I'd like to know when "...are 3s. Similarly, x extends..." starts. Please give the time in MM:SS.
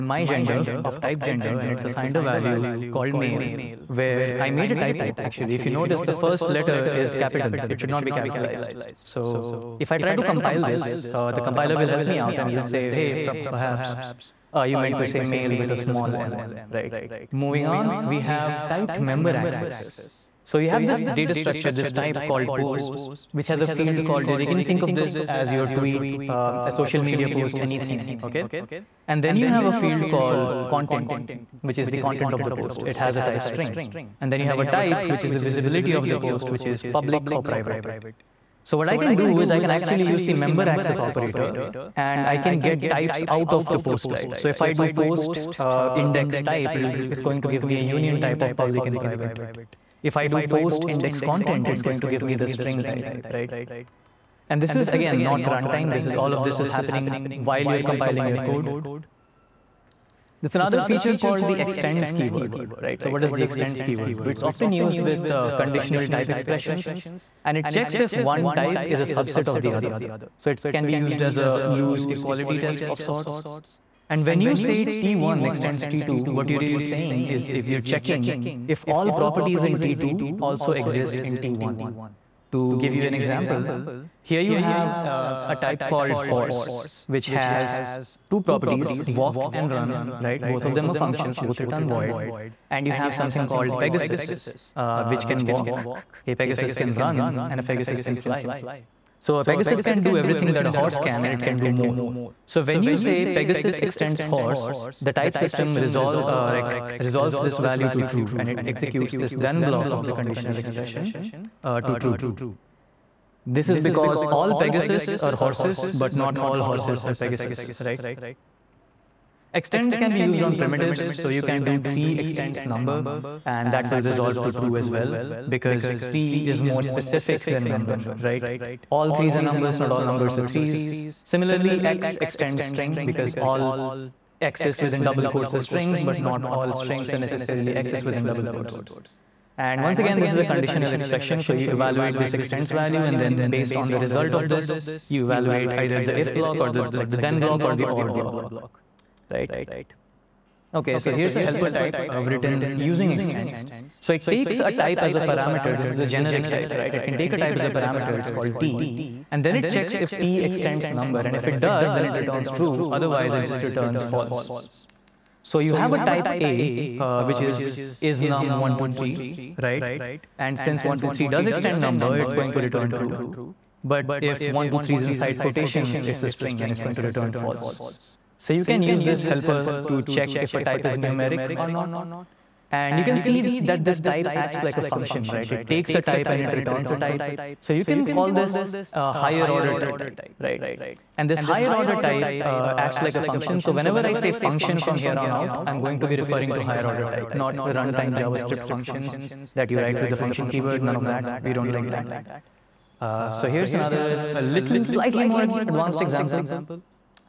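02:10.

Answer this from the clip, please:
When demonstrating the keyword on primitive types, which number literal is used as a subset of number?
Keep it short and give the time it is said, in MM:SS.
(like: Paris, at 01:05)
3, at 02:01.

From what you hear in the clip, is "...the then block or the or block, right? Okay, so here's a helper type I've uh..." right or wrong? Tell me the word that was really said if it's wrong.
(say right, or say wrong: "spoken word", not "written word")
right.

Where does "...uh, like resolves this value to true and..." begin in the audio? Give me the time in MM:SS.
01:46.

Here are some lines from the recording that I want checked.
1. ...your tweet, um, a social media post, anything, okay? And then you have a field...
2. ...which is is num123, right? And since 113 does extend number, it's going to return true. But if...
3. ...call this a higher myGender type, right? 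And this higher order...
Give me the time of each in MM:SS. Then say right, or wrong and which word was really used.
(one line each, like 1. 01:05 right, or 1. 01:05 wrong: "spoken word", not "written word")
1. 00:25 right
2. 02:47 wrong: "123", not "113"
3. 03:08 wrong: "order", not "myGender".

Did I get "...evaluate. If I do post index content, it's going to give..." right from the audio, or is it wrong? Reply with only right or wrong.
wrong.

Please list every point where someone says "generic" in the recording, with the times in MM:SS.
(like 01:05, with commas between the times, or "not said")
02:36.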